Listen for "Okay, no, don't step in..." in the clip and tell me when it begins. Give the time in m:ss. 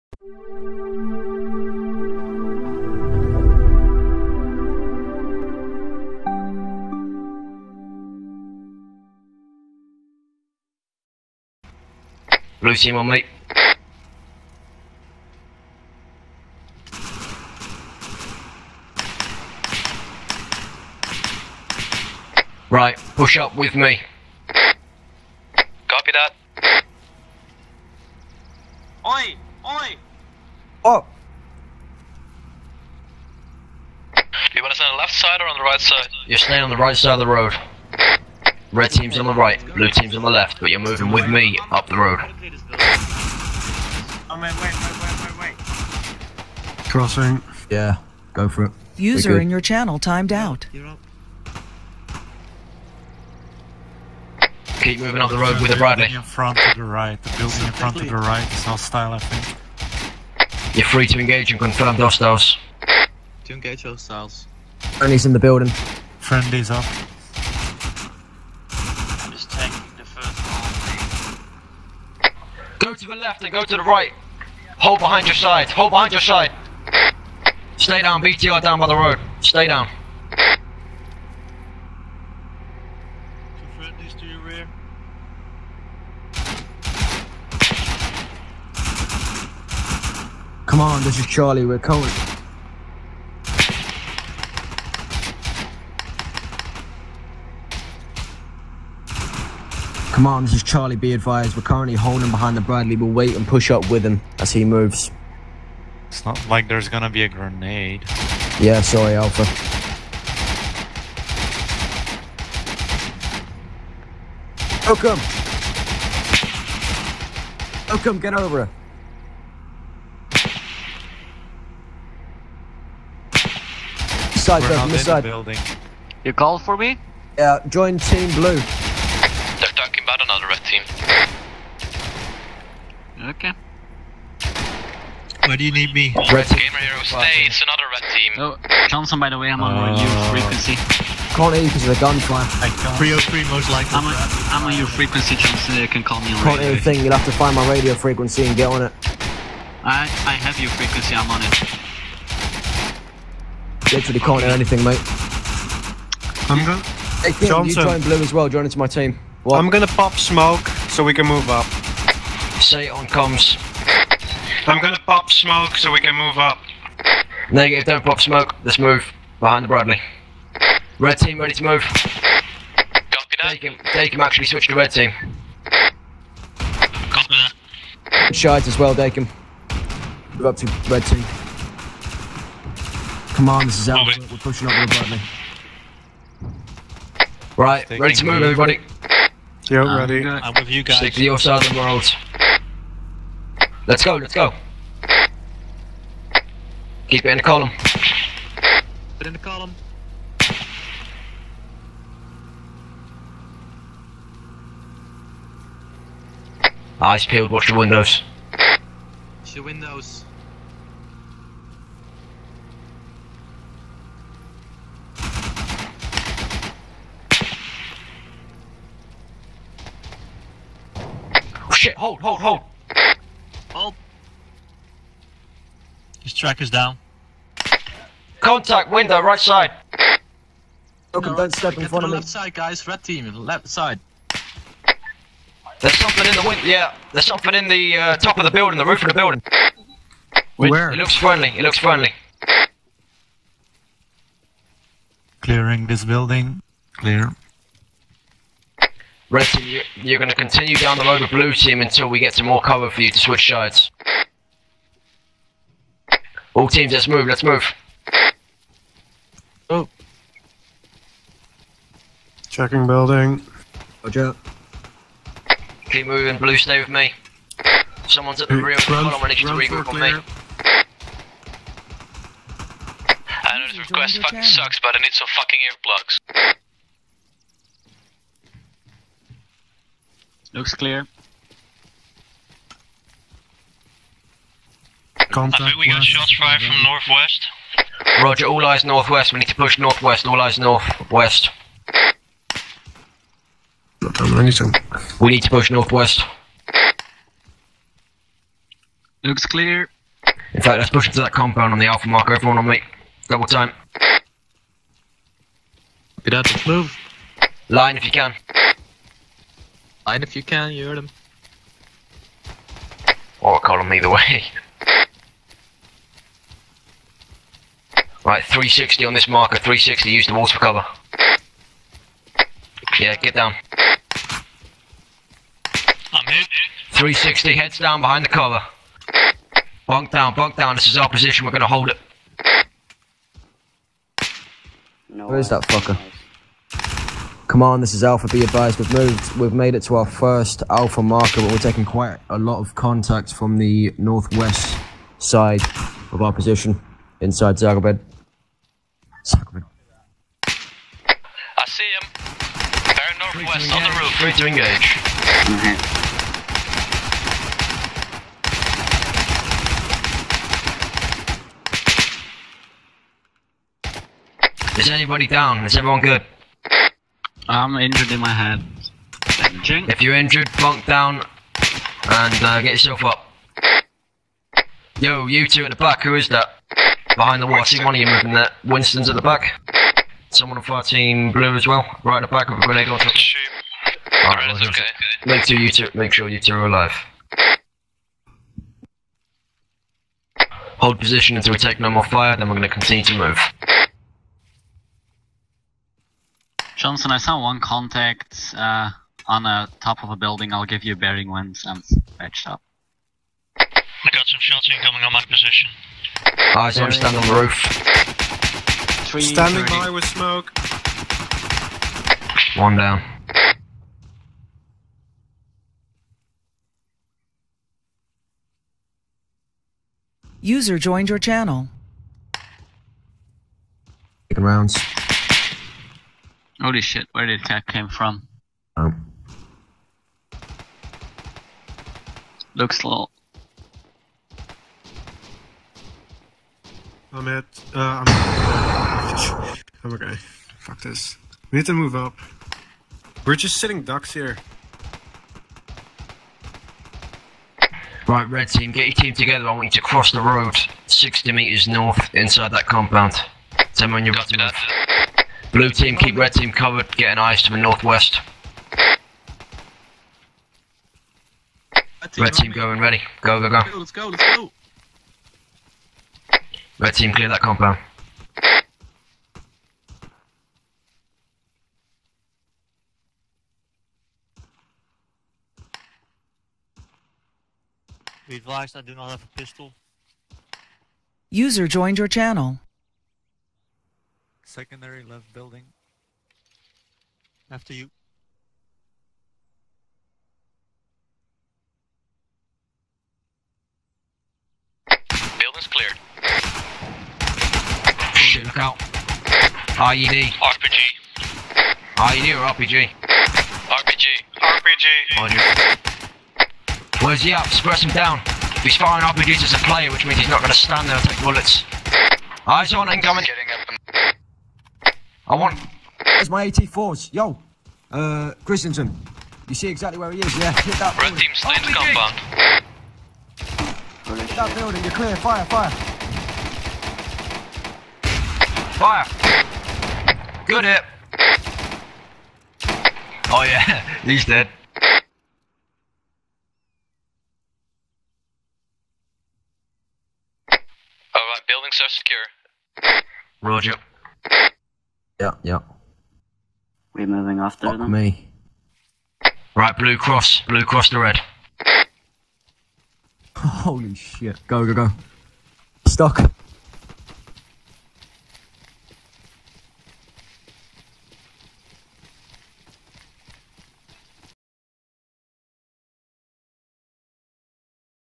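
3:51.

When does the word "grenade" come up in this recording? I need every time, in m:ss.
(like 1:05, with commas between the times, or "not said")
1:47, 6:22.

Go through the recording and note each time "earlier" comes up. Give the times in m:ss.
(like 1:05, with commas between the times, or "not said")
not said.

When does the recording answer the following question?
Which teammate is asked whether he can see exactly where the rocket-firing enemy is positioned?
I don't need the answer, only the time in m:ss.
8:38.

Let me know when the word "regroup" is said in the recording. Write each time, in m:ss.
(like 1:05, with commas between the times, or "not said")
4:29.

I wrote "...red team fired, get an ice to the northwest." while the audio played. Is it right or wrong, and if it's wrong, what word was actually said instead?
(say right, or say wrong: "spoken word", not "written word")
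wrong: "covered", not "fired".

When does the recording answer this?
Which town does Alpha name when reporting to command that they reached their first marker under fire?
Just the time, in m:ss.
5:47.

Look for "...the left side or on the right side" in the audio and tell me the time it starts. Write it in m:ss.
0:34.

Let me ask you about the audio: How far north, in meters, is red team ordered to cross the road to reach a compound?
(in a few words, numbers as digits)
60 meters.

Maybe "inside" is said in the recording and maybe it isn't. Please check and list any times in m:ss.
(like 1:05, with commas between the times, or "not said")
5:47, 7:32.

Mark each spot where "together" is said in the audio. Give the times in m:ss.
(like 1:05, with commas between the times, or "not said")
7:29.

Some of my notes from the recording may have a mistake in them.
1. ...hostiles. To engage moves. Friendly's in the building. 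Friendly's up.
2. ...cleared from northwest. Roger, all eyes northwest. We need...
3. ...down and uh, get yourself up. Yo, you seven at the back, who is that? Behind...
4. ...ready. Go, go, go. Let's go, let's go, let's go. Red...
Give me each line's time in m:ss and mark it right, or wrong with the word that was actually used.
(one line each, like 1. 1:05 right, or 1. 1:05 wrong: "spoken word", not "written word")
1. 1:01 wrong: "hostiles", not "moves"
2. 4:46 wrong: "fired", not "cleared"
3. 6:10 wrong: "two", not "seven"
4. 7:42 right.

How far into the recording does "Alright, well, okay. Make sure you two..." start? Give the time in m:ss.
6:24.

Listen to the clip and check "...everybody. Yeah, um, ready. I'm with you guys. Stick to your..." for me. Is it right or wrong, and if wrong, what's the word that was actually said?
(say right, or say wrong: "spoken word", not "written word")
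right.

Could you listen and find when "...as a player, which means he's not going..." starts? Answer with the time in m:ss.
8:29.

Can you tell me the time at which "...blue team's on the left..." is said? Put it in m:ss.
0:39.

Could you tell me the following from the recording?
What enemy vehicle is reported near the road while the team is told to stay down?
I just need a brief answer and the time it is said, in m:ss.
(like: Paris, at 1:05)
BTR, at 1:18.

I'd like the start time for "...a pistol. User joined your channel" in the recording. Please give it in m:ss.
7:59.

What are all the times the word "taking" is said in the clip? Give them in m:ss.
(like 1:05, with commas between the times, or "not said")
1:09, 5:41, 7:04.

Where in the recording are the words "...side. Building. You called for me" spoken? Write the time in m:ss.
2:05.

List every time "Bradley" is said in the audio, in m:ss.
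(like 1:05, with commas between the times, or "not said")
0:55, 1:42, 2:49.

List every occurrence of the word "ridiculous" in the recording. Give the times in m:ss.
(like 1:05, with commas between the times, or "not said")
not said.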